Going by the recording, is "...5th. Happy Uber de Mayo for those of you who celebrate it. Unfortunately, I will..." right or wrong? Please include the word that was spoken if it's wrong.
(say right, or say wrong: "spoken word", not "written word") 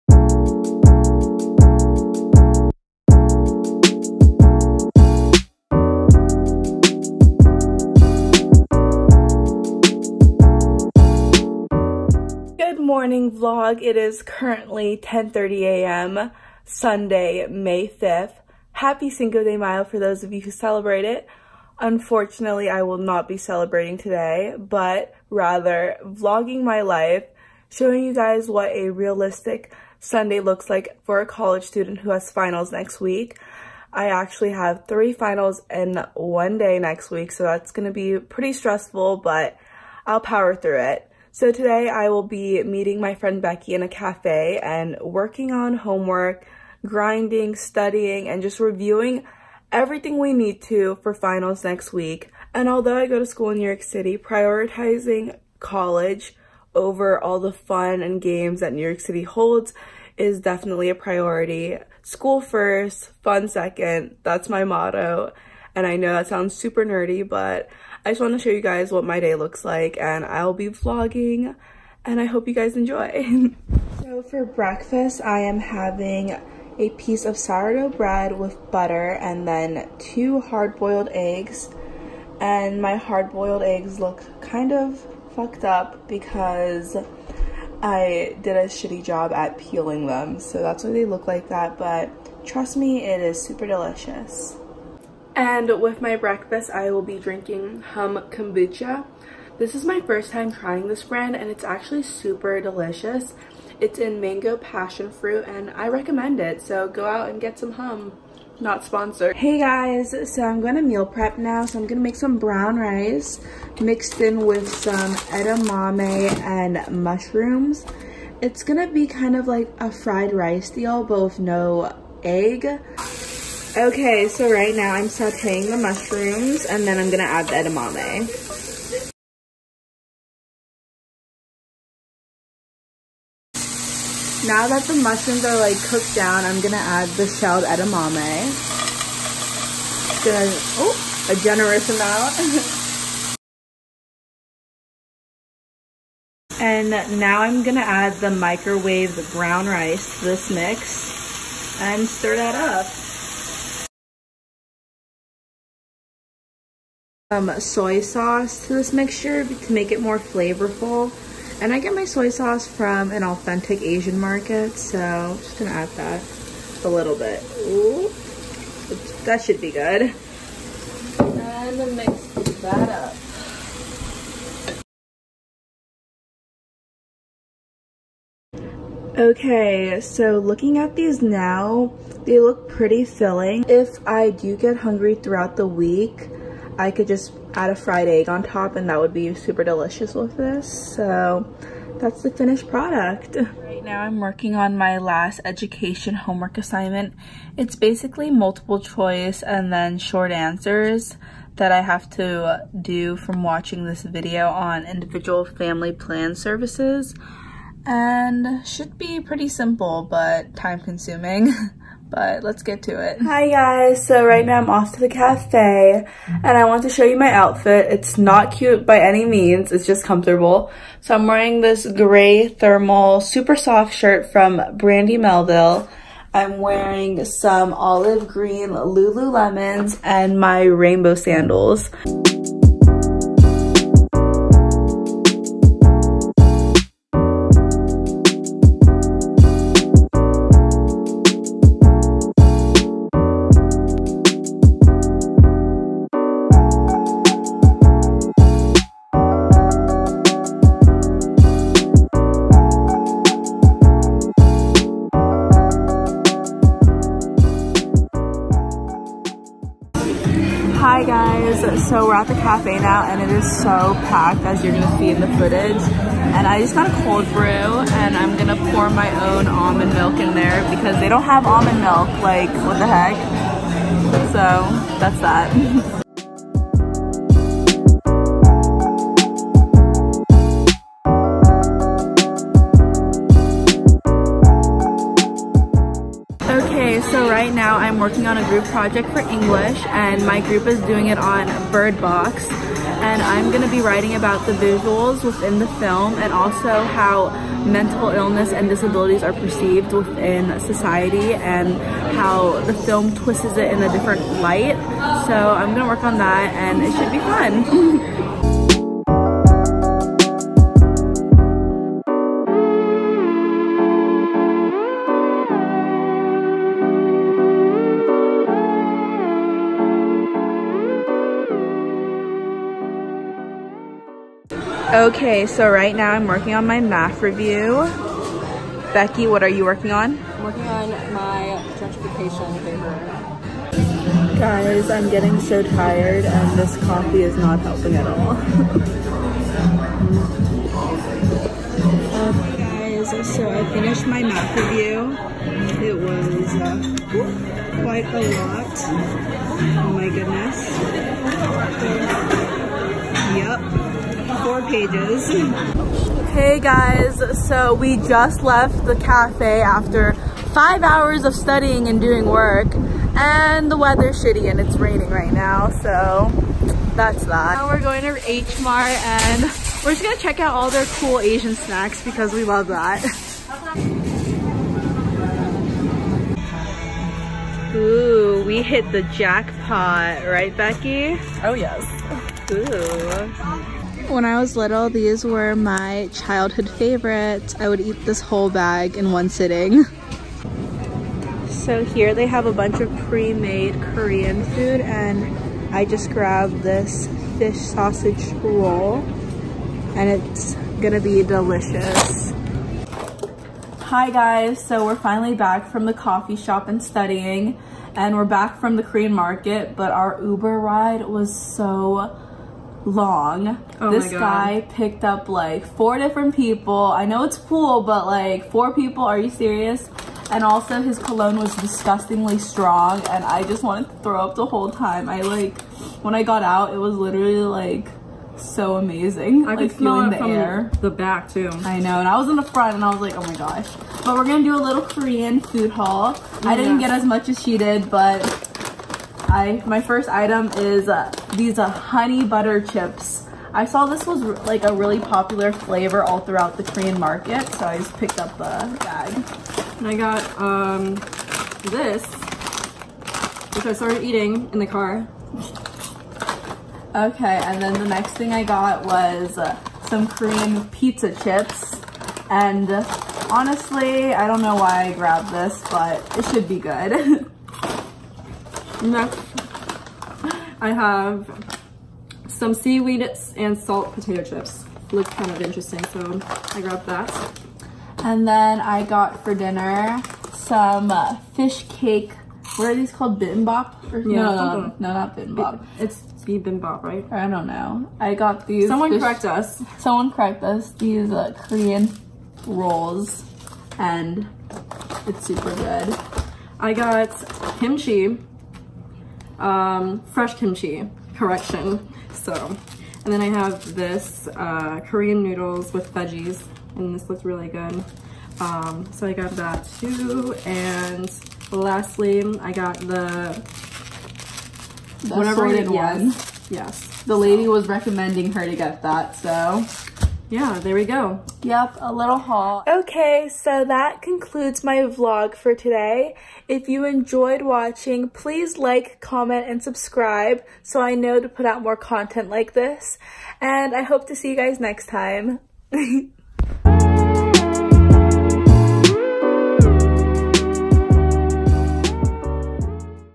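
wrong: "Cinco", not "Uber".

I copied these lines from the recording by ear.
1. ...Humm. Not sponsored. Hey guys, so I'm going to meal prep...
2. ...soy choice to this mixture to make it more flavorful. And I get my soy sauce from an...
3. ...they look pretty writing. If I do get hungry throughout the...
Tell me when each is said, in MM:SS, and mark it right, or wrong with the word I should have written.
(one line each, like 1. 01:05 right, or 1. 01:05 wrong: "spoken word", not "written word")
1. 01:47 right
2. 02:37 wrong: "sauce", not "choice"
3. 03:02 wrong: "filling", not "writing".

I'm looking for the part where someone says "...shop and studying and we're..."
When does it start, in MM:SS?
06:46.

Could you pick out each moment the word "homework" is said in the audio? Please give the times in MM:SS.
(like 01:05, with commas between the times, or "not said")
00:45, 03:16.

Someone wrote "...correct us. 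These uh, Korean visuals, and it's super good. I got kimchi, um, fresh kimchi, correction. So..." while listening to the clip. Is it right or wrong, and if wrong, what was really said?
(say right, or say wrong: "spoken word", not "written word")
wrong: "rolls", not "visuals".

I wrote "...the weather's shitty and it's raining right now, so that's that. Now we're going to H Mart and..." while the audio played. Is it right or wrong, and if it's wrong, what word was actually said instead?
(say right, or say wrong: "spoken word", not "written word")
right.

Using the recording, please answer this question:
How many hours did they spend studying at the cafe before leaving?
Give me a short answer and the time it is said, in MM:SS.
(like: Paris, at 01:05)
5, at 06:00.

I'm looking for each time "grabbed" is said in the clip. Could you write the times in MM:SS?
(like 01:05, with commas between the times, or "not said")
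06:36, 07:44, 07:56.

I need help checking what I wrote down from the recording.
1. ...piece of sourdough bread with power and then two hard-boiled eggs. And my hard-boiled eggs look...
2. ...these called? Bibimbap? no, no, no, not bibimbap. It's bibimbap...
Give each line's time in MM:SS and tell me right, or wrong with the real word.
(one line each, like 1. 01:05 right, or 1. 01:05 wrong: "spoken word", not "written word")
1. 01:16 wrong: "butter", not "power"
2. 08:02 right.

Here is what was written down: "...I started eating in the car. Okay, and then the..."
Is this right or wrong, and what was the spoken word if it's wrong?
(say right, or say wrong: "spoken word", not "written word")
right.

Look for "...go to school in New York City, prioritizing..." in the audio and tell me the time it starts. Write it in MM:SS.
00:53.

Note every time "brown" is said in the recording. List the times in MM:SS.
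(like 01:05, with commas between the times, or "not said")
01:52, 02:29.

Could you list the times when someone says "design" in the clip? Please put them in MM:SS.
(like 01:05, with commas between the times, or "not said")
not said.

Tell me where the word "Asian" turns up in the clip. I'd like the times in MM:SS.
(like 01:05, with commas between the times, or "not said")
02:43, 06:11.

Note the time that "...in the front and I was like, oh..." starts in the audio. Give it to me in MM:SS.
07:12.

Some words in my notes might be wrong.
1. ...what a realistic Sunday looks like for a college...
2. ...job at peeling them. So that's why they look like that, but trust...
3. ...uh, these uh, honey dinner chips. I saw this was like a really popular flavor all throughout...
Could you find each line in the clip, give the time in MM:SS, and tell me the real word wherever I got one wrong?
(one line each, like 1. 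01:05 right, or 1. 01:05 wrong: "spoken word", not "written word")
1. 00:28 right
2. 01:29 right
3. 07:20 wrong: "butter", not "dinner".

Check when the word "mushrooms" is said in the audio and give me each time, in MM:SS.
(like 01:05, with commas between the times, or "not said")
01:57, 02:05, 02:14.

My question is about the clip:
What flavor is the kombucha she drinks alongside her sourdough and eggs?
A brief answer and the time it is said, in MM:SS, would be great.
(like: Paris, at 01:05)
Mango passion fruit, at 01:44.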